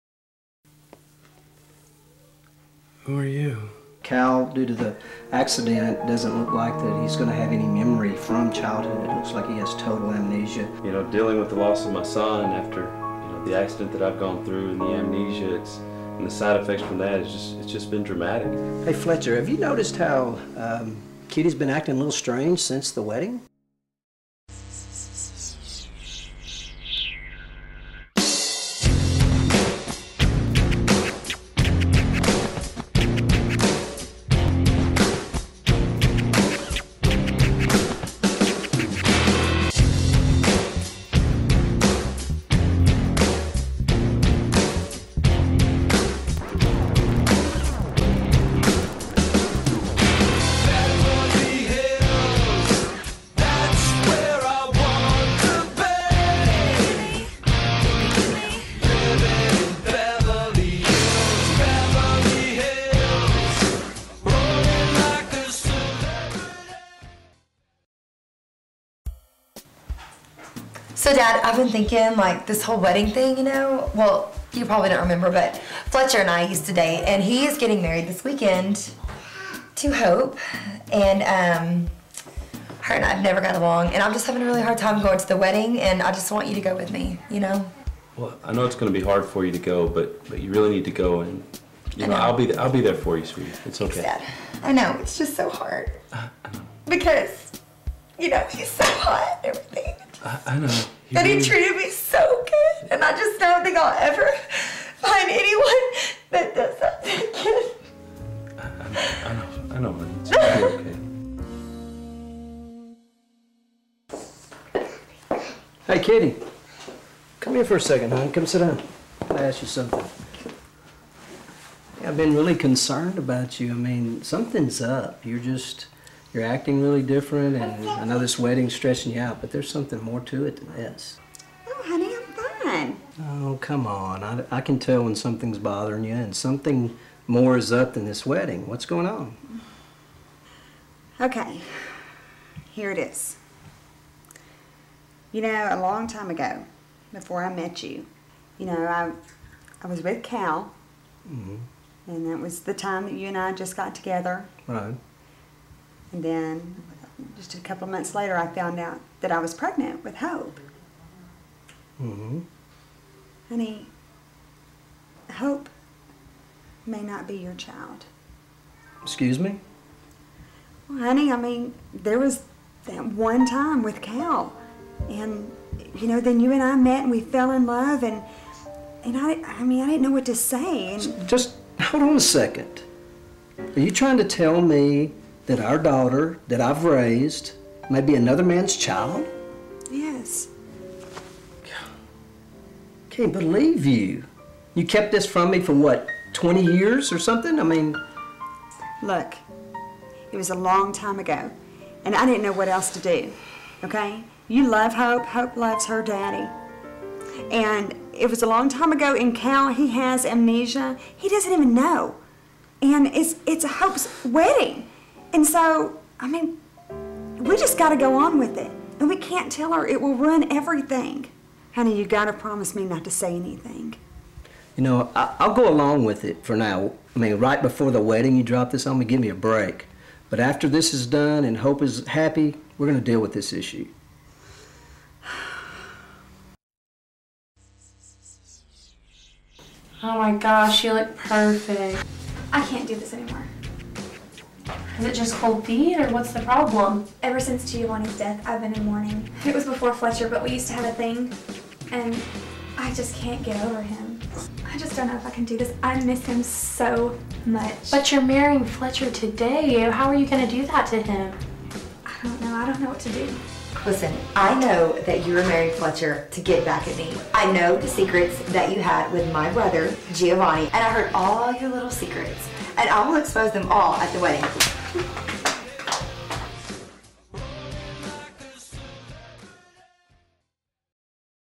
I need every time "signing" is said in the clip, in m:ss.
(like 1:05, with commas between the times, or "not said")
not said.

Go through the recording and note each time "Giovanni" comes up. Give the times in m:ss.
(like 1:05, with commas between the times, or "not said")
4:07, 4:30.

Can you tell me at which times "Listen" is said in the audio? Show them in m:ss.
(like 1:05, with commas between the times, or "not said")
4:23.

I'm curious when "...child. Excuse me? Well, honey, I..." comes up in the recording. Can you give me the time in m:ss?
2:47.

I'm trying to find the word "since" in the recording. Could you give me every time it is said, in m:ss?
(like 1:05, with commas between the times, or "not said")
0:22, 4:07.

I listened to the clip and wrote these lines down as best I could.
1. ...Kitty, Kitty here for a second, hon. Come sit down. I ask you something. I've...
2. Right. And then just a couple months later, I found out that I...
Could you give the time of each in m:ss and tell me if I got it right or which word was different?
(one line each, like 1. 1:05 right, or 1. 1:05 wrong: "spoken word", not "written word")
1. 1:55 wrong: "Come", not "Kitty"
2. 2:34 right.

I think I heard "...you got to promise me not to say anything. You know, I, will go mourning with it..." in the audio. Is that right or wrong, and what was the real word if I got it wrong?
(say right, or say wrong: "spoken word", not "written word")
wrong: "along", not "mourning".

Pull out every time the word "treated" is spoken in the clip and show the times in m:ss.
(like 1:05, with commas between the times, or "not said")
1:41.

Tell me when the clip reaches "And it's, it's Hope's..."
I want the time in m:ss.
3:32.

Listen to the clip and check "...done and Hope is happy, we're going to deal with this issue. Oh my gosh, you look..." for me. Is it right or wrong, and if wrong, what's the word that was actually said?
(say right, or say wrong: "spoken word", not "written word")
right.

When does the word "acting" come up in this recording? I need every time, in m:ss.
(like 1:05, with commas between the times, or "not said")
0:21, 2:06.